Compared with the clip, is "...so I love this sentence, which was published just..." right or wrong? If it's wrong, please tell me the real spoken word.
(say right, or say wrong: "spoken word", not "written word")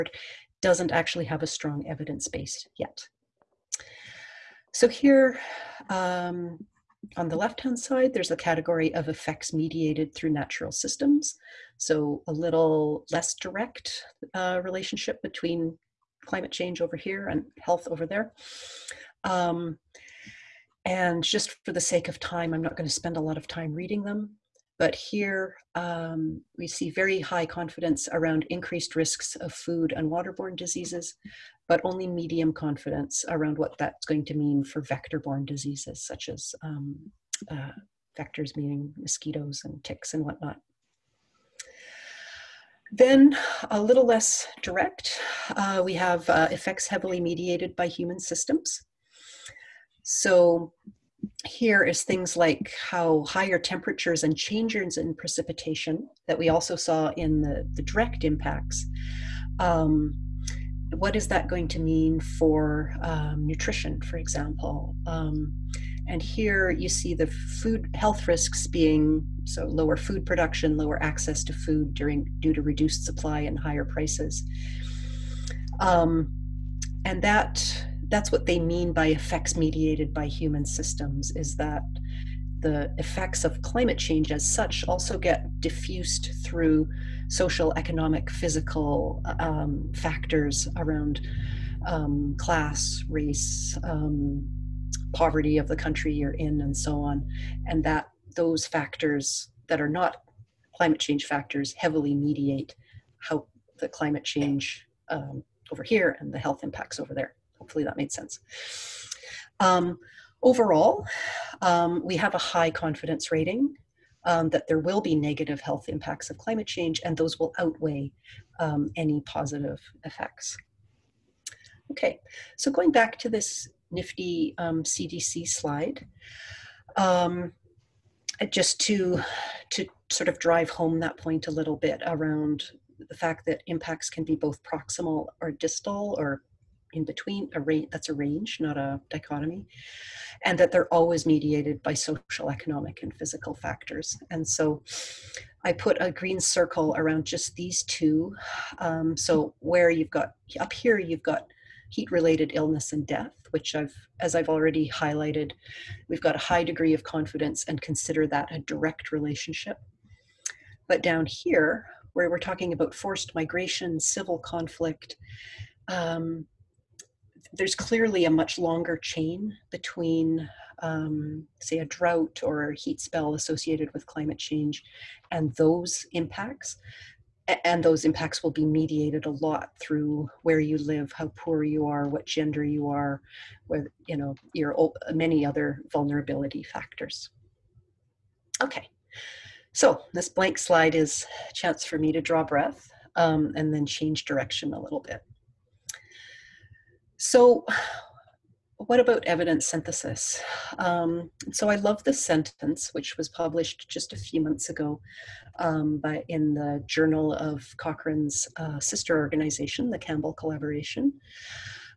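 right.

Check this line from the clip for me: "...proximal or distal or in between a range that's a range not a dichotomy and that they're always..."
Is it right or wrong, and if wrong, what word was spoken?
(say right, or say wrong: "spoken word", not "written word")
right.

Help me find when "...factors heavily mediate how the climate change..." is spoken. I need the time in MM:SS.
01:41.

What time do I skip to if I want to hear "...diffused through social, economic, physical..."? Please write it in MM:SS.
01:25.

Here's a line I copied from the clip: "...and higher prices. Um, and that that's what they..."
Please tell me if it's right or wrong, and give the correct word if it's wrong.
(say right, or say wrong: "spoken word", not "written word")
right.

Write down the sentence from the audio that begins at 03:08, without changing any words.
Okay, so this blank slide is a chance for me to draw breath um, and then change direction a little bit.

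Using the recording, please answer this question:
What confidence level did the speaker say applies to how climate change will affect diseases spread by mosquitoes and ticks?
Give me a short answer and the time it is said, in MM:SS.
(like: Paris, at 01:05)
medium confidence, at 00:32.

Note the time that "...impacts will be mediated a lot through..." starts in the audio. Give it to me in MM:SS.
02:58.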